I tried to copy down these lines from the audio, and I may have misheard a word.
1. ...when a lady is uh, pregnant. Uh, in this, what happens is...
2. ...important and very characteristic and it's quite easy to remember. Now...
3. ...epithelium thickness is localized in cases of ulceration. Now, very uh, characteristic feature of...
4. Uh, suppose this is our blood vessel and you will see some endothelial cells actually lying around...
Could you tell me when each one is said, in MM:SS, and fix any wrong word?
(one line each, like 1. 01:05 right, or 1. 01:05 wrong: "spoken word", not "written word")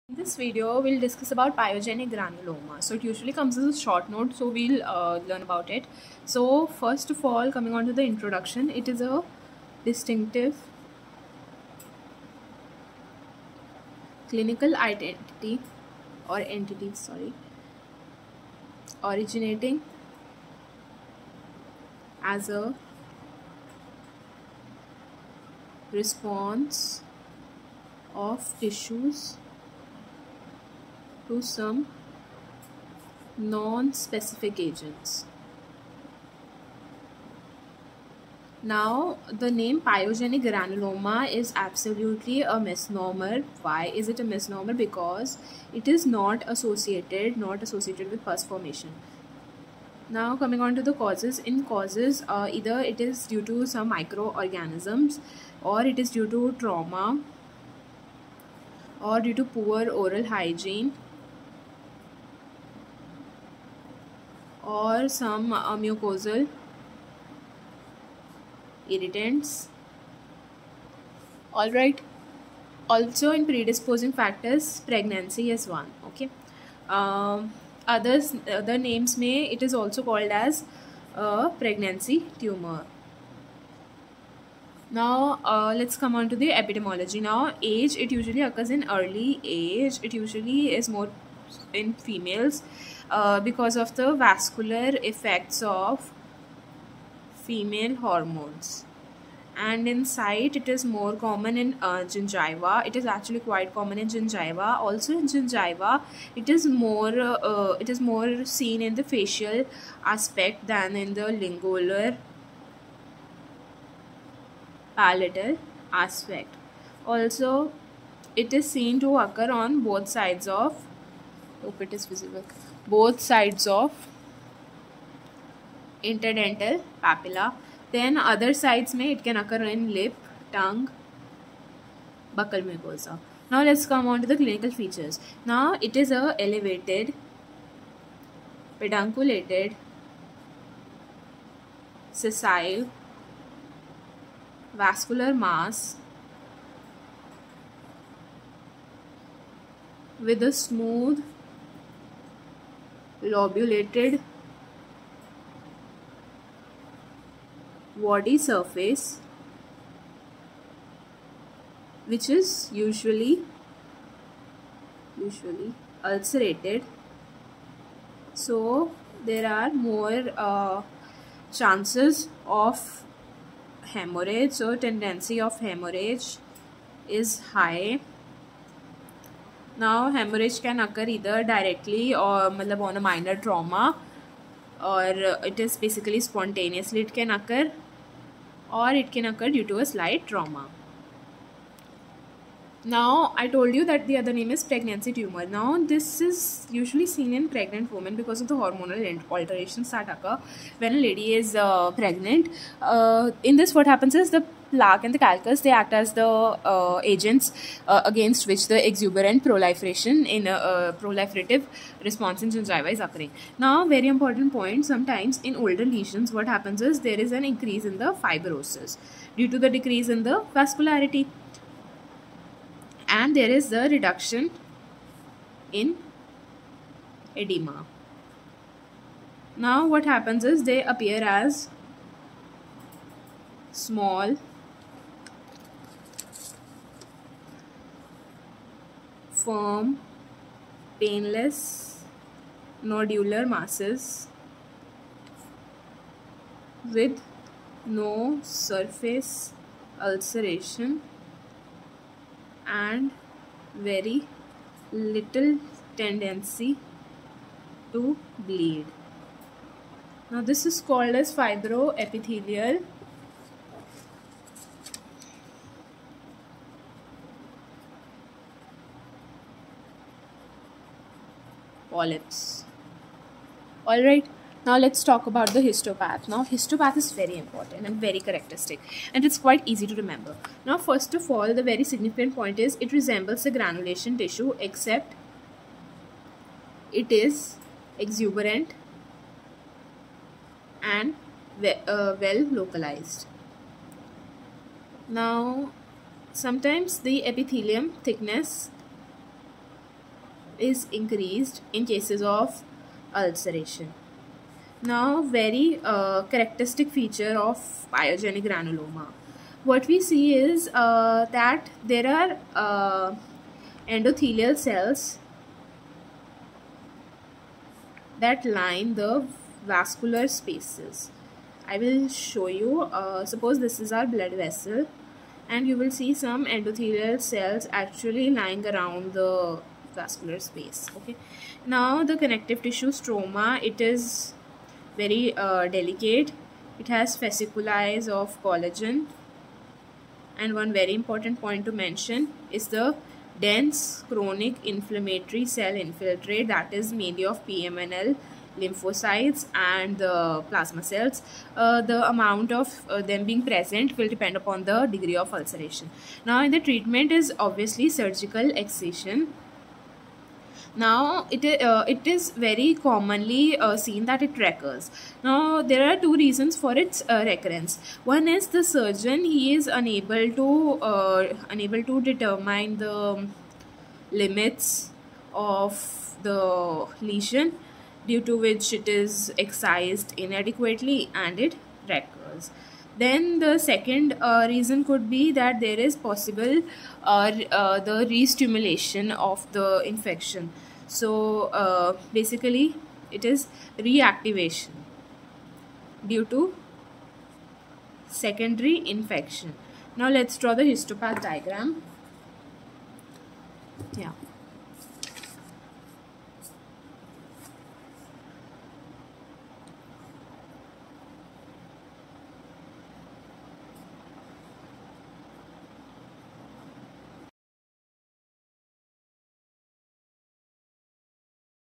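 1. 03:20 right
2. 04:37 right
3. 04:57 wrong: "increased", not "localized"
4. 05:22 right.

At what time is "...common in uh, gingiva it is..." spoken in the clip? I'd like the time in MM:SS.
01:41.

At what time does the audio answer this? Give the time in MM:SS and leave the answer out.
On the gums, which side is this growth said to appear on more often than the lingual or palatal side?
01:49.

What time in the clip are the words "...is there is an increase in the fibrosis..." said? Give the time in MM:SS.
03:36.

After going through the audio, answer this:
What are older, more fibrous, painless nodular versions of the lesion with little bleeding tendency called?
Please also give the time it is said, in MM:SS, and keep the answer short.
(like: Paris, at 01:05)
Fibroepithelial polyps, at 04:21.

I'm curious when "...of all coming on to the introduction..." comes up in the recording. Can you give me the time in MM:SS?
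00:07.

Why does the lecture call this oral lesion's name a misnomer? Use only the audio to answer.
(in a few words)
Pus formation.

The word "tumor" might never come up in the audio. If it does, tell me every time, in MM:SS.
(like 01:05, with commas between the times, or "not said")
01:22, 03:15.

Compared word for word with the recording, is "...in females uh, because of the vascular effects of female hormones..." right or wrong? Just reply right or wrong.
right.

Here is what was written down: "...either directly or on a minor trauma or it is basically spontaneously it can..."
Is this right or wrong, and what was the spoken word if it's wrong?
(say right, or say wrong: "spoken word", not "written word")
right.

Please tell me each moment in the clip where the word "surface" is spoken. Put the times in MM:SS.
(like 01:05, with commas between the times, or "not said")
02:38, 04:08.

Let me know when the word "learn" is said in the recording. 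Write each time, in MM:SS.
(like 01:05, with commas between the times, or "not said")
00:05.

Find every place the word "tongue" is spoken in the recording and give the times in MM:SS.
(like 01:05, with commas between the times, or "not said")
02:10.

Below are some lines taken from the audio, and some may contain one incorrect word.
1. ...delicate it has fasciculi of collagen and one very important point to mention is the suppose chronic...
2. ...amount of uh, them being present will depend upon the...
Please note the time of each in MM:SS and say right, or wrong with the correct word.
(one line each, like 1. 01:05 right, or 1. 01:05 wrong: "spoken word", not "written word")
1. 05:35 wrong: "dense", not "suppose"
2. 05:52 right.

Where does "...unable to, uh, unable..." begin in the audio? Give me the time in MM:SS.
06:09.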